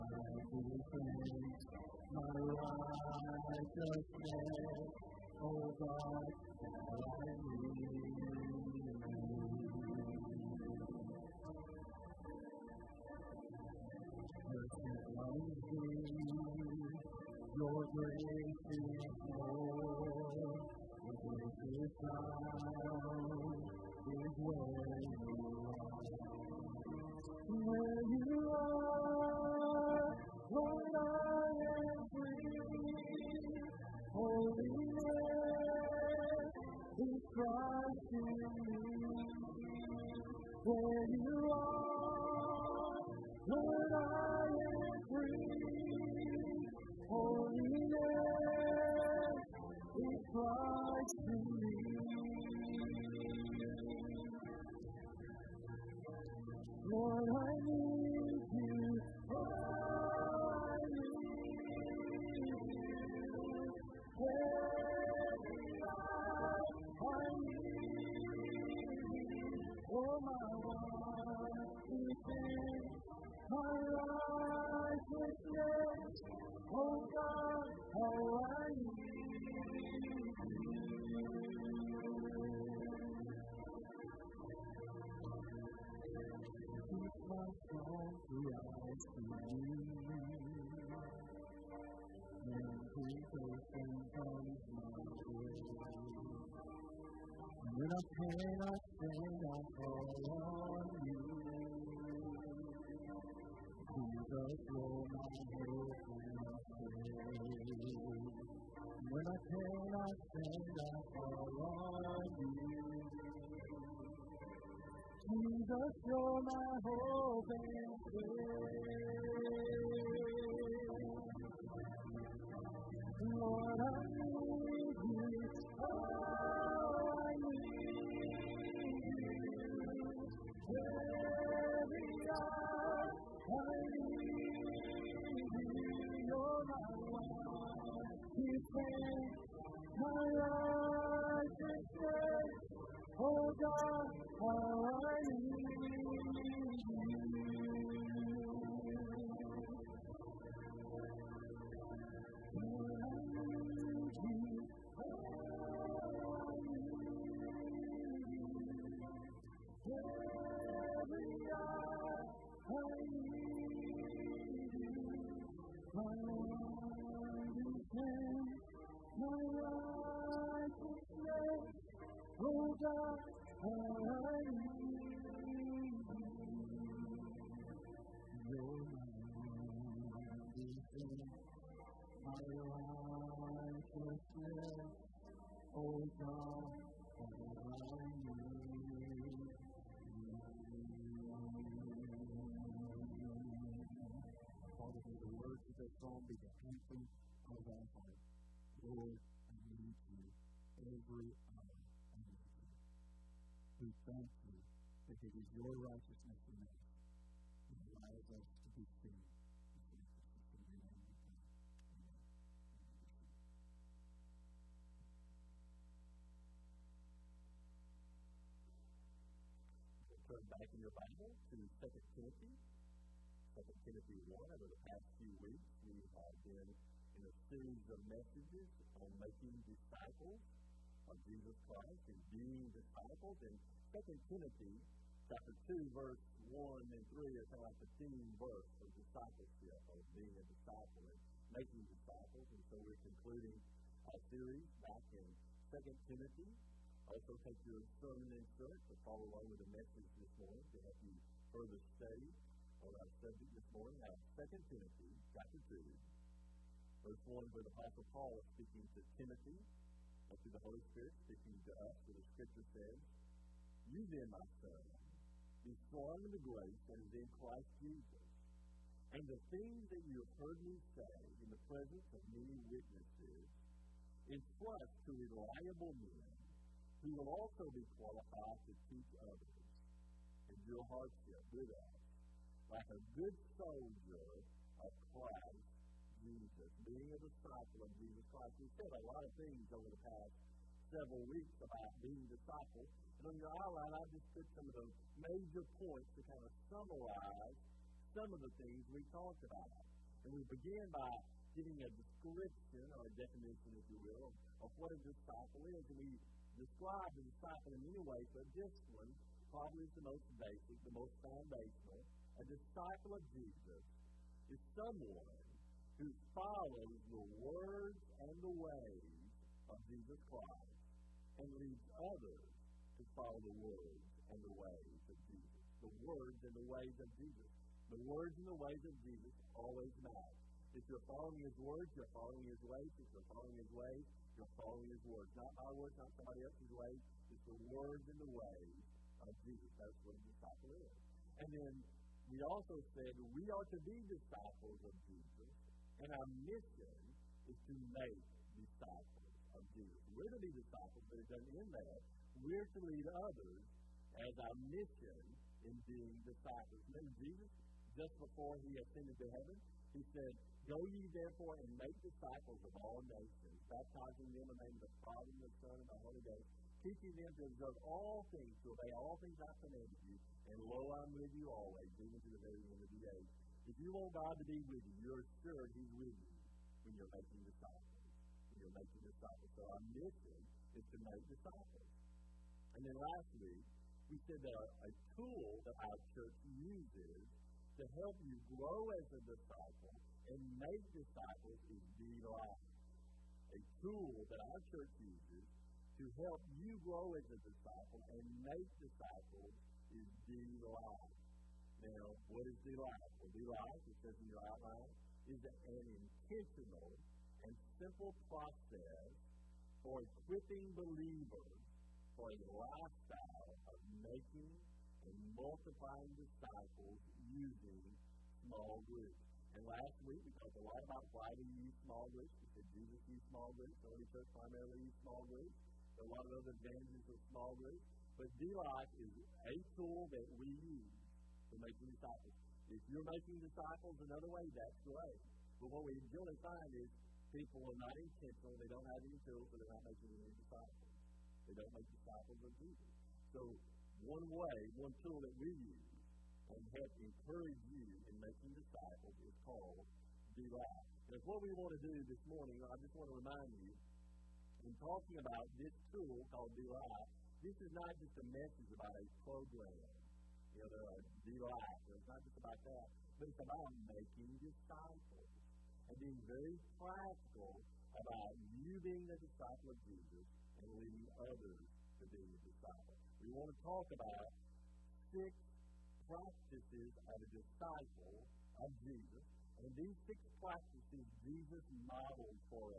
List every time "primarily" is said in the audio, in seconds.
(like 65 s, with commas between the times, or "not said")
424 s.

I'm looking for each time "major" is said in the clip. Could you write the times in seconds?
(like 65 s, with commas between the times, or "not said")
295 s.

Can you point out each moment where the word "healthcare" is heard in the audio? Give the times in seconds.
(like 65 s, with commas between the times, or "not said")
not said.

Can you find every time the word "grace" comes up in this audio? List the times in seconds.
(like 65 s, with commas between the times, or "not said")
17 s, 266 s.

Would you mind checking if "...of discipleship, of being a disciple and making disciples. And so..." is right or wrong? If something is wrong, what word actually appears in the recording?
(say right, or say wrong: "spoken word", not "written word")
right.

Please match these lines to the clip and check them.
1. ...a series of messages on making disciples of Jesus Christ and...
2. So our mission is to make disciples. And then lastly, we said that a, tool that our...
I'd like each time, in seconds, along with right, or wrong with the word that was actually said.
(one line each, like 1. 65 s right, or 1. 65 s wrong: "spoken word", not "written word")
1. 227 s right
2. 379 s right.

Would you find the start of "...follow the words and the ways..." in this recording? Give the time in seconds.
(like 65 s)
323 s.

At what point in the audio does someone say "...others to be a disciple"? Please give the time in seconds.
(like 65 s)
471 s.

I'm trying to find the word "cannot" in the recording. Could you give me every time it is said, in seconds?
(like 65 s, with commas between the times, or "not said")
98 s, 109 s.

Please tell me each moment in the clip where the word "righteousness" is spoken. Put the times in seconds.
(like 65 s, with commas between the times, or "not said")
140 s, 205 s.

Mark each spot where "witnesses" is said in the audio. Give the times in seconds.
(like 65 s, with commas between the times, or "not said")
272 s.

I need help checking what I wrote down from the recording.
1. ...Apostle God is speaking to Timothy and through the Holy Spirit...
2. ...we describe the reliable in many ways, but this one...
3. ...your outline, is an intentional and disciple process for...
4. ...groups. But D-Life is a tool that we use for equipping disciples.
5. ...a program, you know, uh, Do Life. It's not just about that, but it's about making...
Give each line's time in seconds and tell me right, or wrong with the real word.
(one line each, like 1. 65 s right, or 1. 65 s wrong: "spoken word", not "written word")
1. 257 s wrong: "Paul", not "God"
2. 306 s wrong: "disciple", not "reliable"
3. 404 s wrong: "simple", not "disciple"
4. 427 s wrong: "making", not "equipping"
5. 458 s right.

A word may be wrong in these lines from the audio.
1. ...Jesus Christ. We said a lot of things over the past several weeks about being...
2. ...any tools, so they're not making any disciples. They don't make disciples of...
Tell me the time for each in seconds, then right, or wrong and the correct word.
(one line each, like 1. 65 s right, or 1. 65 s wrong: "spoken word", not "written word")
1. 288 s right
2. 439 s right.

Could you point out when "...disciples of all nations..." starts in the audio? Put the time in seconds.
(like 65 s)
362 s.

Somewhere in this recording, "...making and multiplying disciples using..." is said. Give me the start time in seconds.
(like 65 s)
414 s.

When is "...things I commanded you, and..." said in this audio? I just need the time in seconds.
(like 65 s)
369 s.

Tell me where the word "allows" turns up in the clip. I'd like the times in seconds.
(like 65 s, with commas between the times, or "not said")
207 s.